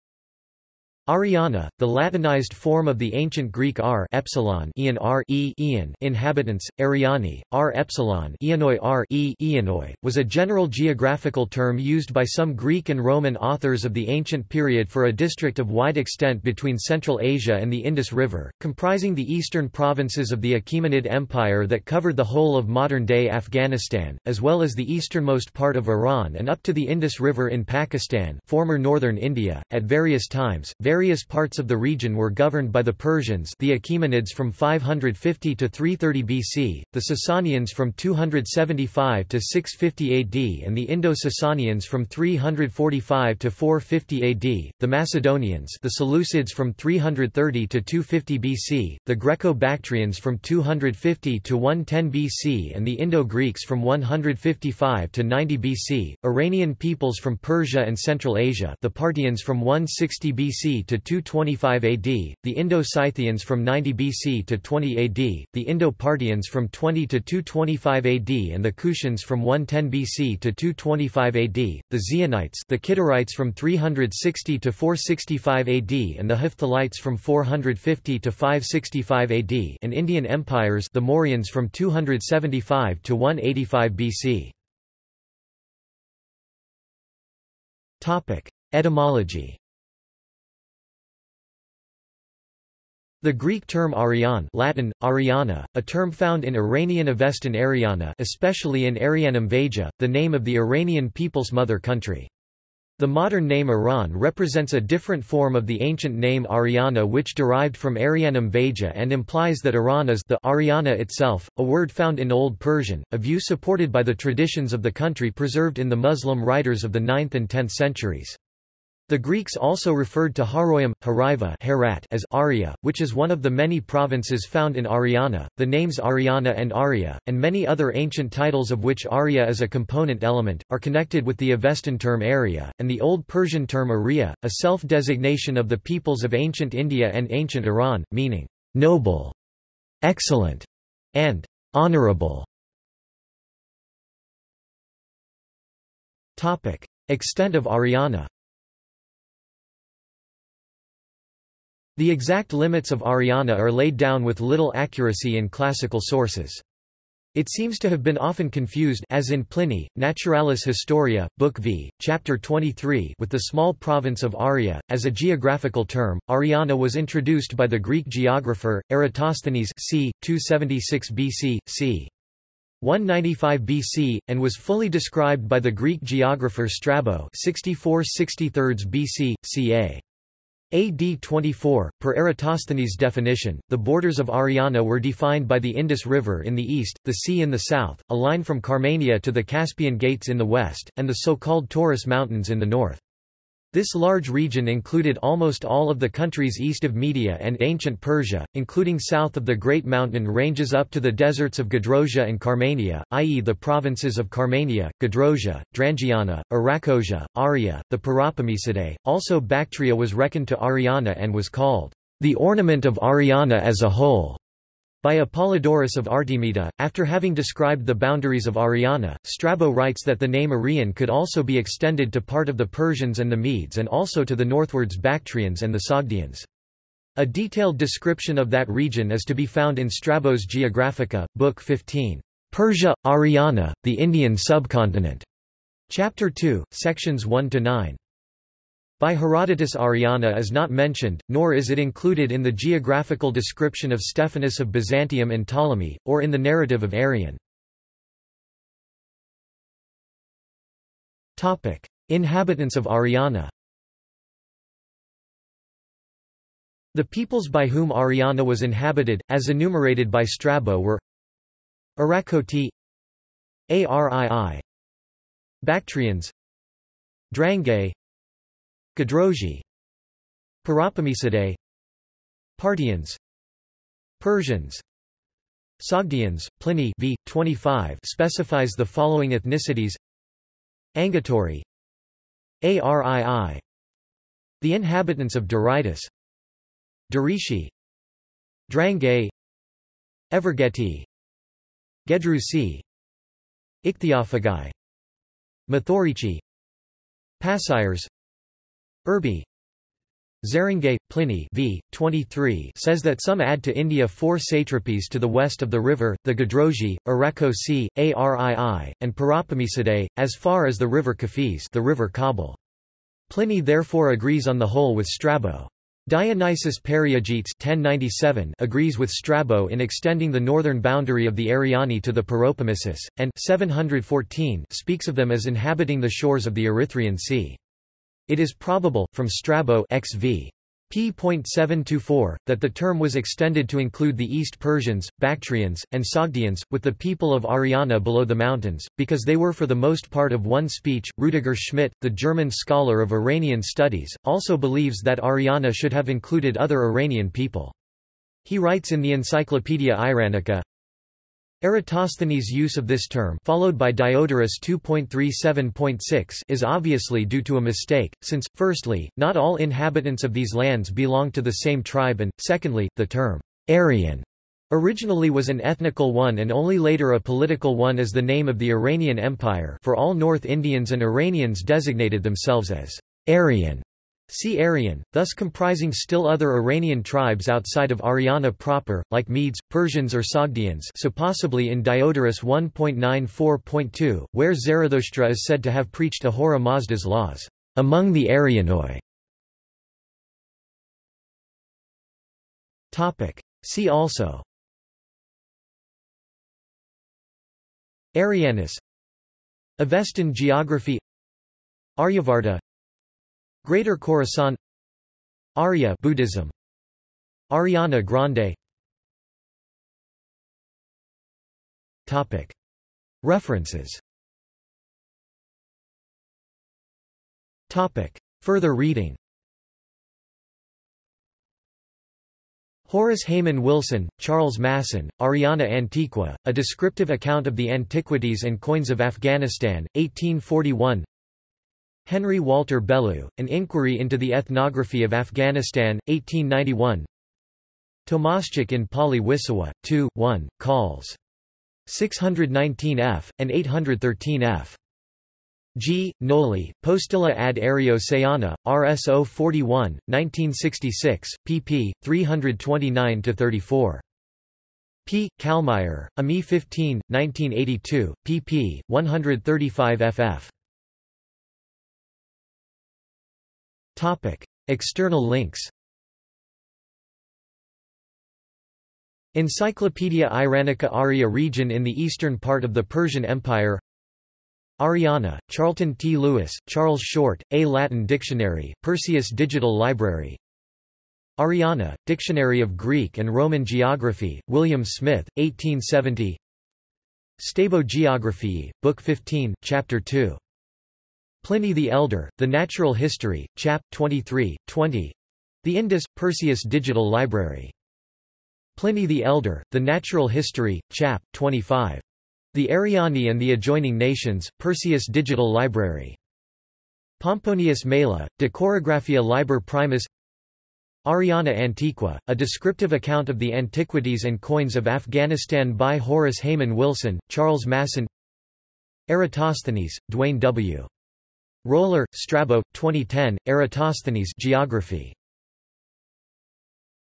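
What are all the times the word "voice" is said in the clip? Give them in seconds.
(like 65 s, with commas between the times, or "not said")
not said.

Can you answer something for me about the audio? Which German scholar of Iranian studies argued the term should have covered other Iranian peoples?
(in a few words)
Rudiger Schmitt.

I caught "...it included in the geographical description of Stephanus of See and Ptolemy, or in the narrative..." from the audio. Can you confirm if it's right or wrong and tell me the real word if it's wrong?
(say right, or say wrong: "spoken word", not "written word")
wrong: "Byzantium", not "See".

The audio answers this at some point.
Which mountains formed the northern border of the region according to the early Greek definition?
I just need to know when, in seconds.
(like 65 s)
191 s.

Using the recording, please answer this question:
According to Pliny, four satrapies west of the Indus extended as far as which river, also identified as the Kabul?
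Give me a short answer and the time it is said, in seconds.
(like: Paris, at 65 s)
Kafis, at 310 s.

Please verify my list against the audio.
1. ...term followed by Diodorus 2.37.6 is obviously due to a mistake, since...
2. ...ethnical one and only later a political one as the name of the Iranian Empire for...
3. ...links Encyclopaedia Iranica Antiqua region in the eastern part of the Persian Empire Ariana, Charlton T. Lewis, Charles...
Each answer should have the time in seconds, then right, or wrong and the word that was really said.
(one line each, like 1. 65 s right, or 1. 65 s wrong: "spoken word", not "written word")
1. 353 s right
2. 365 s right
3. 465 s wrong: "Arya", not "Antiqua".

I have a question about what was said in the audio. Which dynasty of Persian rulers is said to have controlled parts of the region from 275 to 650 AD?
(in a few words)
Sasanians.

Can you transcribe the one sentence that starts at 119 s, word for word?
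The Greeks also referred to Haroium, Hariva Herat as Aria, which is one of the many provinces found in Ariana.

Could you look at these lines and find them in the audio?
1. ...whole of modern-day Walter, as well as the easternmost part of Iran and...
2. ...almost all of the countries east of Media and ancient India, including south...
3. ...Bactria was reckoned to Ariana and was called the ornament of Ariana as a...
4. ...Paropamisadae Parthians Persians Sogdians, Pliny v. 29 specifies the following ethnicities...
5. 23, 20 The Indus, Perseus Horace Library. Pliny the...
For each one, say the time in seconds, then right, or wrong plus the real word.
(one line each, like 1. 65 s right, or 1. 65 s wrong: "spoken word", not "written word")
1. 22 s wrong: "Afghanistan", not "Walter"
2. 195 s wrong: "Persia", not "India"
3. 209 s right
4. 270 s wrong: "25", not "29"
5. 493 s wrong: "Digital", not "Horace".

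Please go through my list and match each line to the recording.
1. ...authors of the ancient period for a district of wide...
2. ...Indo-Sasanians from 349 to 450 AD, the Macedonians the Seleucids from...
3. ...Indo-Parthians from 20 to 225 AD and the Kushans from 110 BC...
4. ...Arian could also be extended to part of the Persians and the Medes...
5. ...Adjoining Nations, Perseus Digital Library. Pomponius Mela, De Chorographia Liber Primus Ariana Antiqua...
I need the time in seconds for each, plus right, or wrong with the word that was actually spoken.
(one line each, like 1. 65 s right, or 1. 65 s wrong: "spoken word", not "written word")
1. 13 s right
2. 40 s wrong: "345", not "349"
3. 65 s right
4. 220 s right
5. 503 s right.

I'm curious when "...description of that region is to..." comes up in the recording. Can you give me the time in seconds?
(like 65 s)
227 s.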